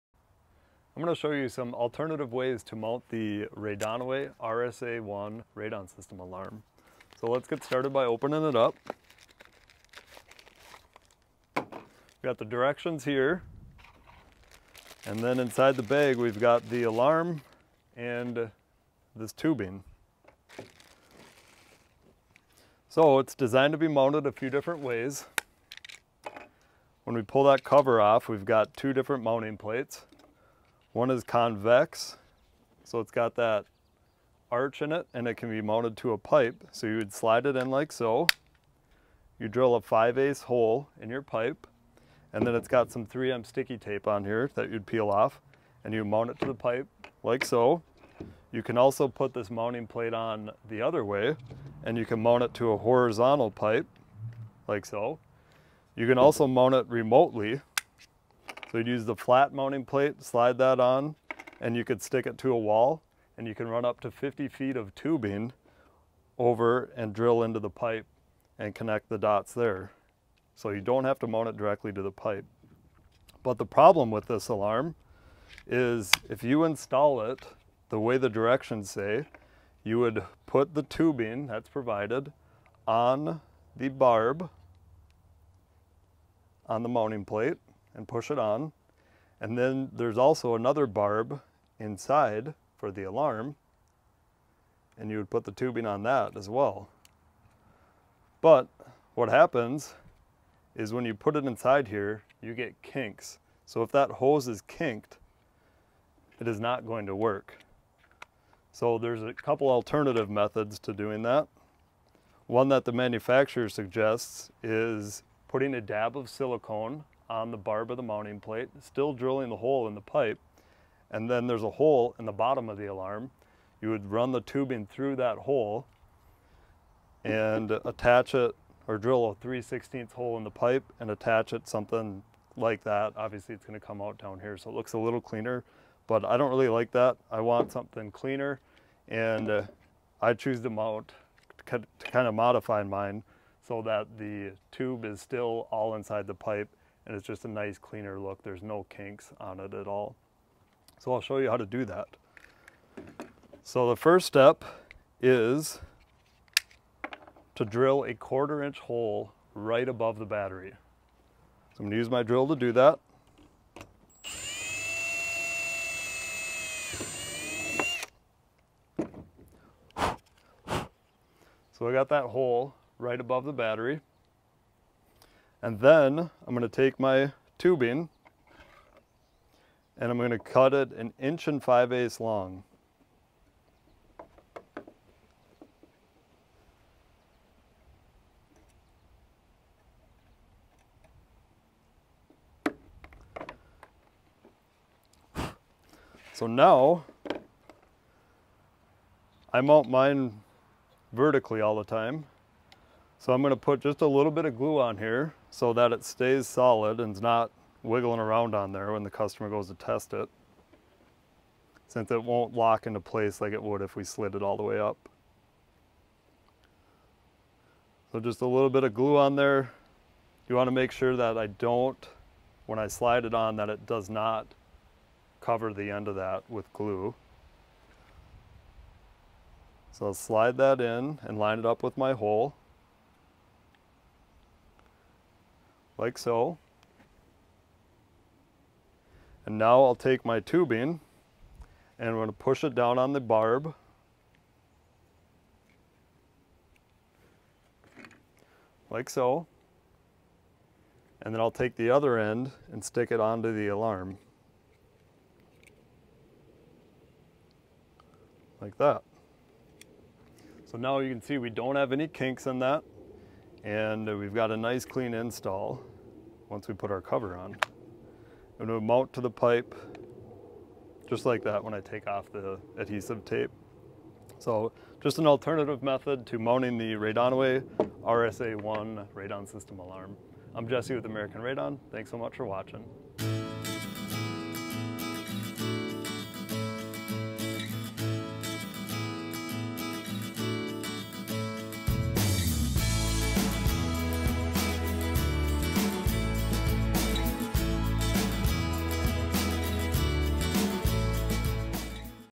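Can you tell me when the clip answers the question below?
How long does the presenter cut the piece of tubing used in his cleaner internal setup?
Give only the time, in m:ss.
3:00.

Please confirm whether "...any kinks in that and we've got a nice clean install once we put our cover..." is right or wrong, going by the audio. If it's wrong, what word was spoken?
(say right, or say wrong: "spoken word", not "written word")
right.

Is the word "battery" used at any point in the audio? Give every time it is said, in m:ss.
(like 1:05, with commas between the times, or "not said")
2:40, 2:53.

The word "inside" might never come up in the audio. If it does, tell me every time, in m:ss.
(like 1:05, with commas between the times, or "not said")
0:15, 1:31, 1:41, 2:25.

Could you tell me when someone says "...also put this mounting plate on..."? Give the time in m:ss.
0:48.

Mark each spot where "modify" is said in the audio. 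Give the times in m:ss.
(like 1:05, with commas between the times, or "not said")
2:22.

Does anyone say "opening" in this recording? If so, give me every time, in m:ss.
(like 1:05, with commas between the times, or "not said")
0:08.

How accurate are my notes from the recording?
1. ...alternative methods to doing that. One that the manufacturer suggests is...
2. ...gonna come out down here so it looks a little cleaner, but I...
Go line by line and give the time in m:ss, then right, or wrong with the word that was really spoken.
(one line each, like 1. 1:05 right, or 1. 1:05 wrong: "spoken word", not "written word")
1. 1:49 right
2. 2:13 right.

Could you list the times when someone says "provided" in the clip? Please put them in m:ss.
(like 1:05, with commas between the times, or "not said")
1:21.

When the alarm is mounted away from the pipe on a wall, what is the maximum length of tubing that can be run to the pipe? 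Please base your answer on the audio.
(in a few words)
50 feet.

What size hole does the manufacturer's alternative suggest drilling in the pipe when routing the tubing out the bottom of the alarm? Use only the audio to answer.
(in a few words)
3/16.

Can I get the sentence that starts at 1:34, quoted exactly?
And you would put the tubing on that as well.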